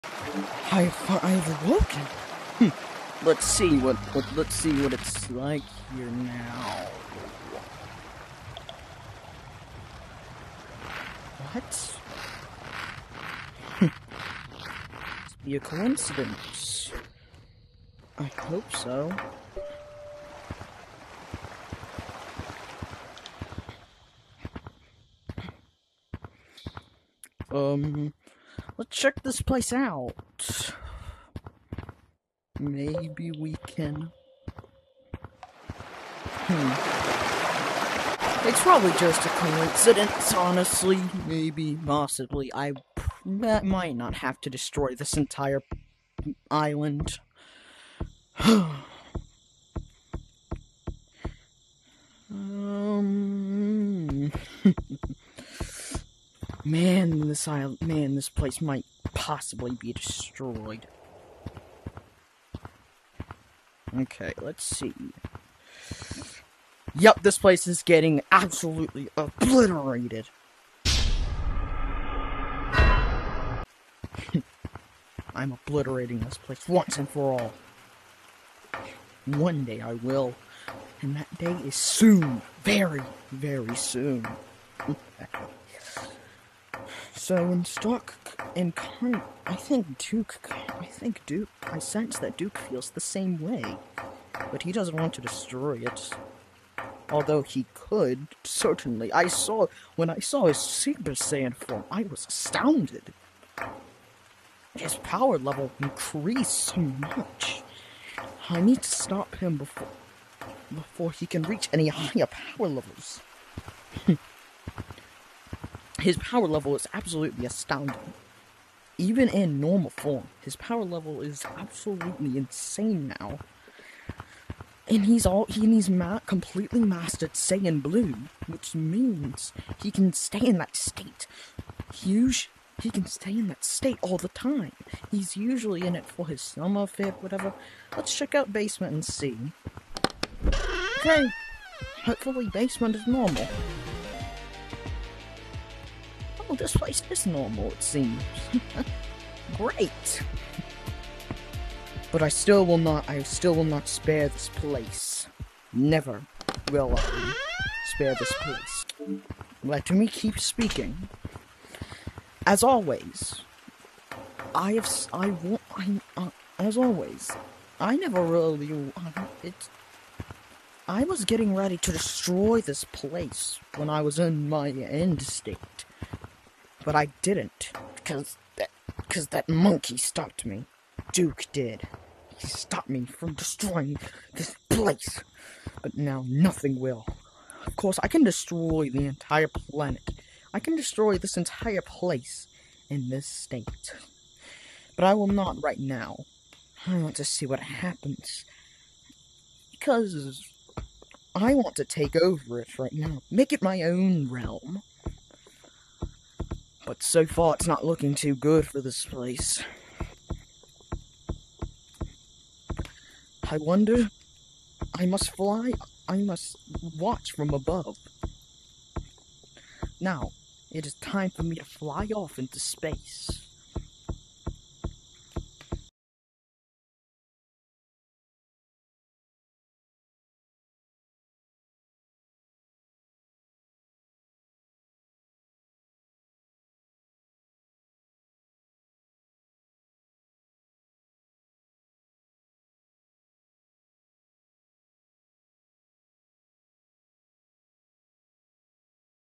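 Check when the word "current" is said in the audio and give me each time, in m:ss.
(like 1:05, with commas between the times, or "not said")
1:28.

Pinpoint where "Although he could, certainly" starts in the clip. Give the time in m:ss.
1:37.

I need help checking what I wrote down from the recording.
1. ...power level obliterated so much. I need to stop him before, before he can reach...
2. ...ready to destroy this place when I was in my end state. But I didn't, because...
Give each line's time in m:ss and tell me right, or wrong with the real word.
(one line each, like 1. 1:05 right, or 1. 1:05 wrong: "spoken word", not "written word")
1. 1:44 wrong: "increased", not "obliterated"
2. 2:51 right.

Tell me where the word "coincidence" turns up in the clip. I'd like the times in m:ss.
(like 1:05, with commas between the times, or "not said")
0:15, 0:39.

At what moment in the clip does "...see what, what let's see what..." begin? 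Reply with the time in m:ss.
0:03.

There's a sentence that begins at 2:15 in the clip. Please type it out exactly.
He's usually in it for his summer fit, whatever.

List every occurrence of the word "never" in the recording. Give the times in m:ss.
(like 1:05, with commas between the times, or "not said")
2:35, 2:47.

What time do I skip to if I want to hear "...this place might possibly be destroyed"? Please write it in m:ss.
0:58.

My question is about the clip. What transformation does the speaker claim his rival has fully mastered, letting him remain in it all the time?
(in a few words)
Saiyan Blue.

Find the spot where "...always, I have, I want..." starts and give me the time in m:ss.
2:42.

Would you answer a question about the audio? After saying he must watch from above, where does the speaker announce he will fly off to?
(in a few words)
Space.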